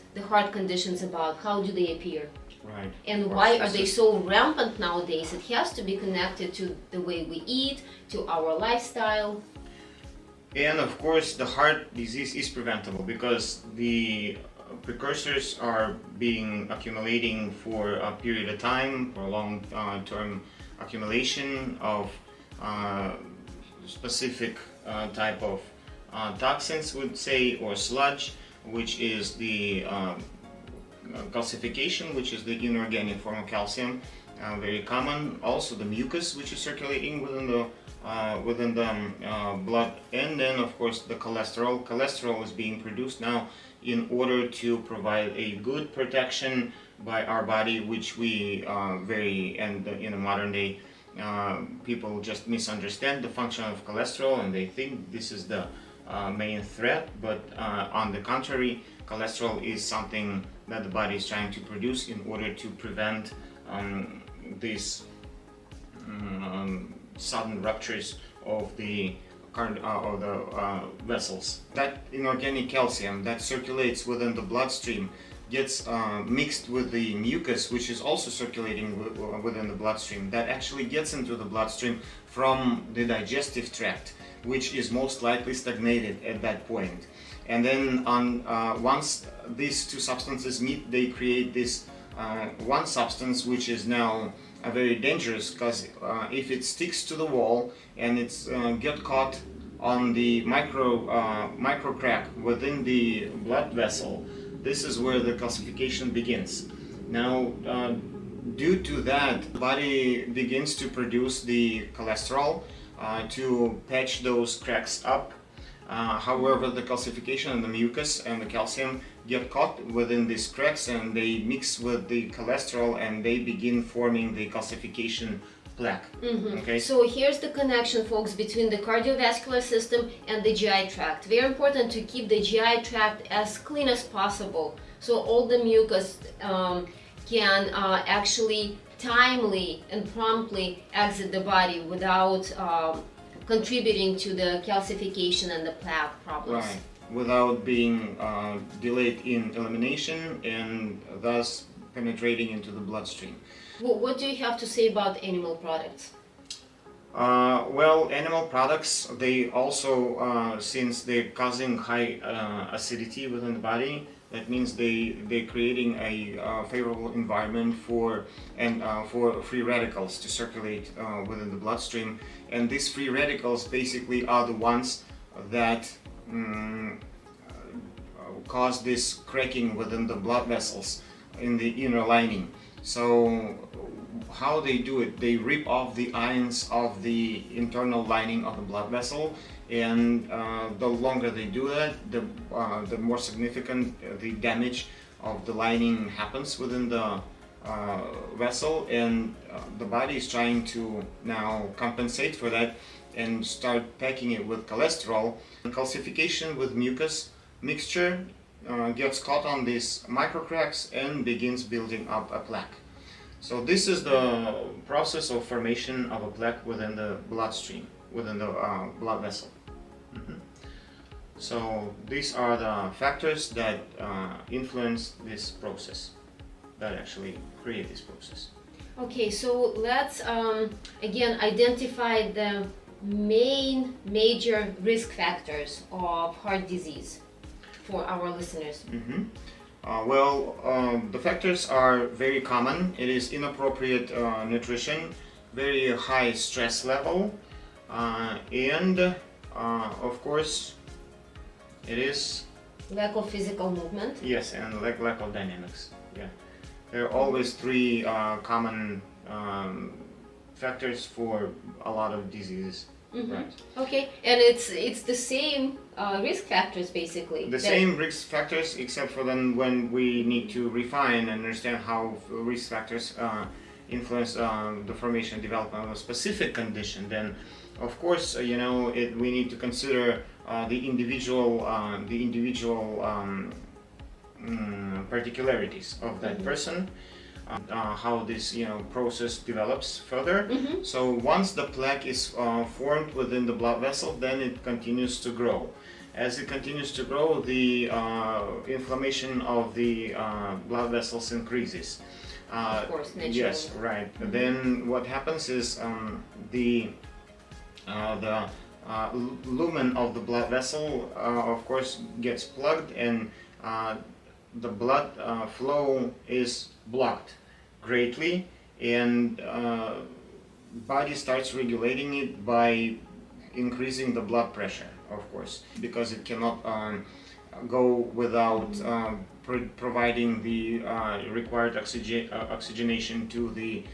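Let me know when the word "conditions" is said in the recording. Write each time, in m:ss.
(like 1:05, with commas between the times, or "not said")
0:00, 4:36.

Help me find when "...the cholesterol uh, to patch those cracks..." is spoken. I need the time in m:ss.
1:51.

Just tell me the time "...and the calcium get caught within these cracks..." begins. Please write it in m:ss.
1:58.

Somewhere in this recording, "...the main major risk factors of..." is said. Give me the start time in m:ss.
3:52.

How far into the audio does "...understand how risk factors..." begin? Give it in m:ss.
4:31.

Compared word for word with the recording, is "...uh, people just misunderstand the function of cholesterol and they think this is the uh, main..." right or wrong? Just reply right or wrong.
right.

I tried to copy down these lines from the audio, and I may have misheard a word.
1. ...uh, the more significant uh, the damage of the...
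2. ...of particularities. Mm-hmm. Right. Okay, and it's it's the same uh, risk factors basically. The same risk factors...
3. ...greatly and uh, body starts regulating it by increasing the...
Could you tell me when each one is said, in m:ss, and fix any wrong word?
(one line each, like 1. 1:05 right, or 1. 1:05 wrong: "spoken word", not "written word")
1. 3:12 right
2. 4:22 wrong: "diseases", not "particularities"
3. 5:17 right.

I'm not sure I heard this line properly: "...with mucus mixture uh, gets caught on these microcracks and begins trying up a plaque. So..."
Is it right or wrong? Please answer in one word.
wrong.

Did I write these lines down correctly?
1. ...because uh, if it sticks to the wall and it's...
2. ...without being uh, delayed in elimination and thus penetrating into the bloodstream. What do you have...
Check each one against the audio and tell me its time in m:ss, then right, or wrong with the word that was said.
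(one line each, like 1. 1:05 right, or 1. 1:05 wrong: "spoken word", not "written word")
1. 1:35 right
2. 2:27 right.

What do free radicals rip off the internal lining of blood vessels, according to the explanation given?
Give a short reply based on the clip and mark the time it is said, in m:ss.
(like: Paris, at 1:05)
ions, at 3:06.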